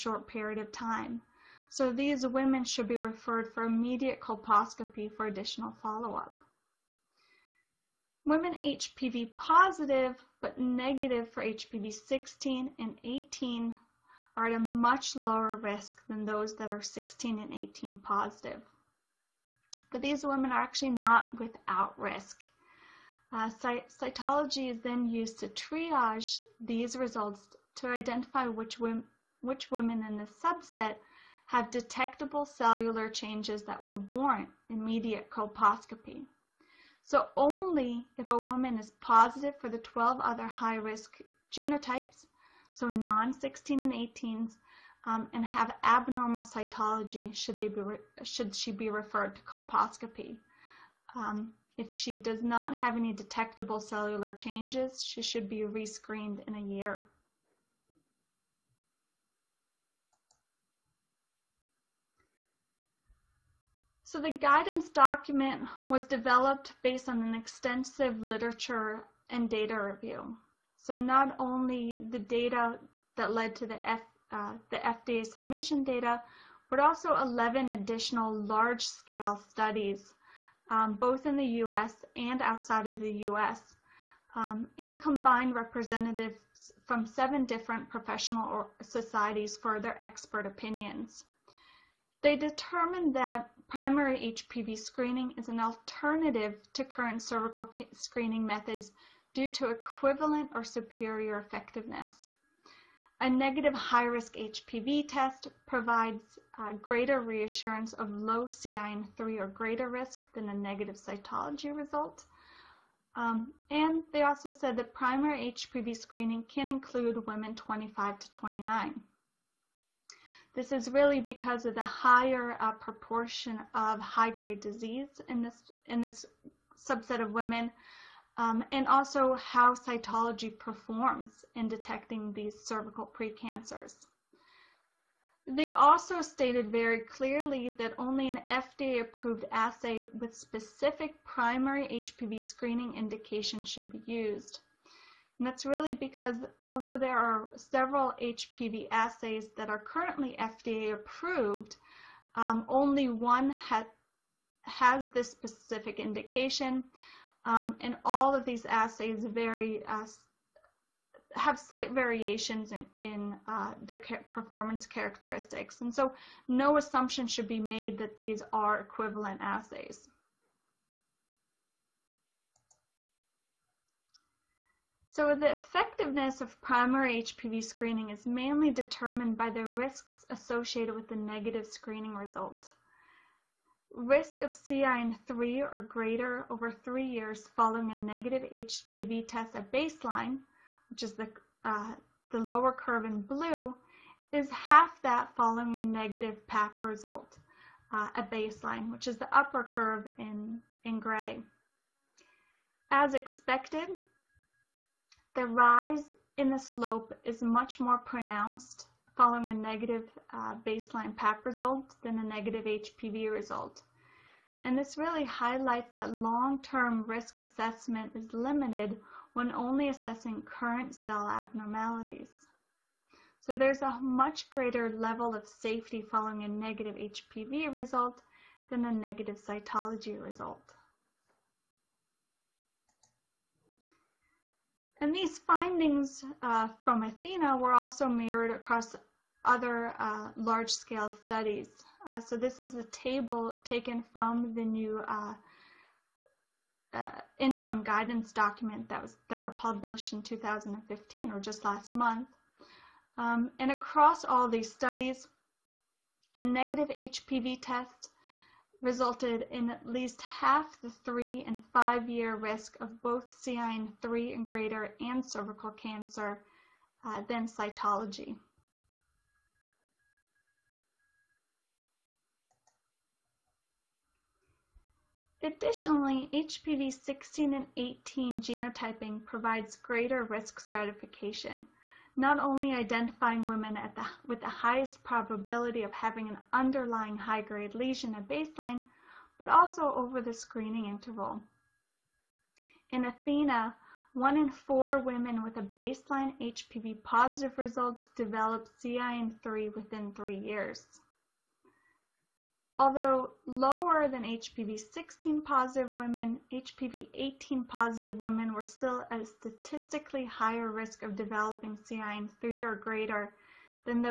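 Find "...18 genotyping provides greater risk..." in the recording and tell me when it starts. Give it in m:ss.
4:37.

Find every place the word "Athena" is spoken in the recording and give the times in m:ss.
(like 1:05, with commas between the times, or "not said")
3:57, 4:53.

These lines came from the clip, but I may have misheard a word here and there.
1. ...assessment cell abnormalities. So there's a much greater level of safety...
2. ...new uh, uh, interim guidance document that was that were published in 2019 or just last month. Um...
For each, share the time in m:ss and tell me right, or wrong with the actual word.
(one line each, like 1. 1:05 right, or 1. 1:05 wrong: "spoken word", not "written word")
1. 3:40 wrong: "current", not "assessment"
2. 4:04 wrong: "2015", not "2019".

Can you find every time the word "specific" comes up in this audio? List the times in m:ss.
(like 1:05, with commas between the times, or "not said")
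2:20, 2:35.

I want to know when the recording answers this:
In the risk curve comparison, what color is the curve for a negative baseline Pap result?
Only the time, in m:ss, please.
3:20.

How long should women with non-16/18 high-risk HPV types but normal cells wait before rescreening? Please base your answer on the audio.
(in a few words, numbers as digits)
a year.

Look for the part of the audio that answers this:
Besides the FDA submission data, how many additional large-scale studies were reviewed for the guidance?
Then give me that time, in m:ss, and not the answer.
1:17.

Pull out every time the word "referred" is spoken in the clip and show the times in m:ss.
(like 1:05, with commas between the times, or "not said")
0:02, 0:48.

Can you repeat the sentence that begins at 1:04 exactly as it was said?
So the guidance document was developed based on an extensive literature and data review.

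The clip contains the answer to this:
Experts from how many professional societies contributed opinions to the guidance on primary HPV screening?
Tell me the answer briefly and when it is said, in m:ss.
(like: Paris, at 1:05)
7, at 1:27.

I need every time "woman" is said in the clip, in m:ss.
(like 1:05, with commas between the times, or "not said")
0:38.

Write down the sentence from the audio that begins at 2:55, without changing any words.
So the effectiveness of primary HPV screening is mainly determined by the risks associated with the negative screening result.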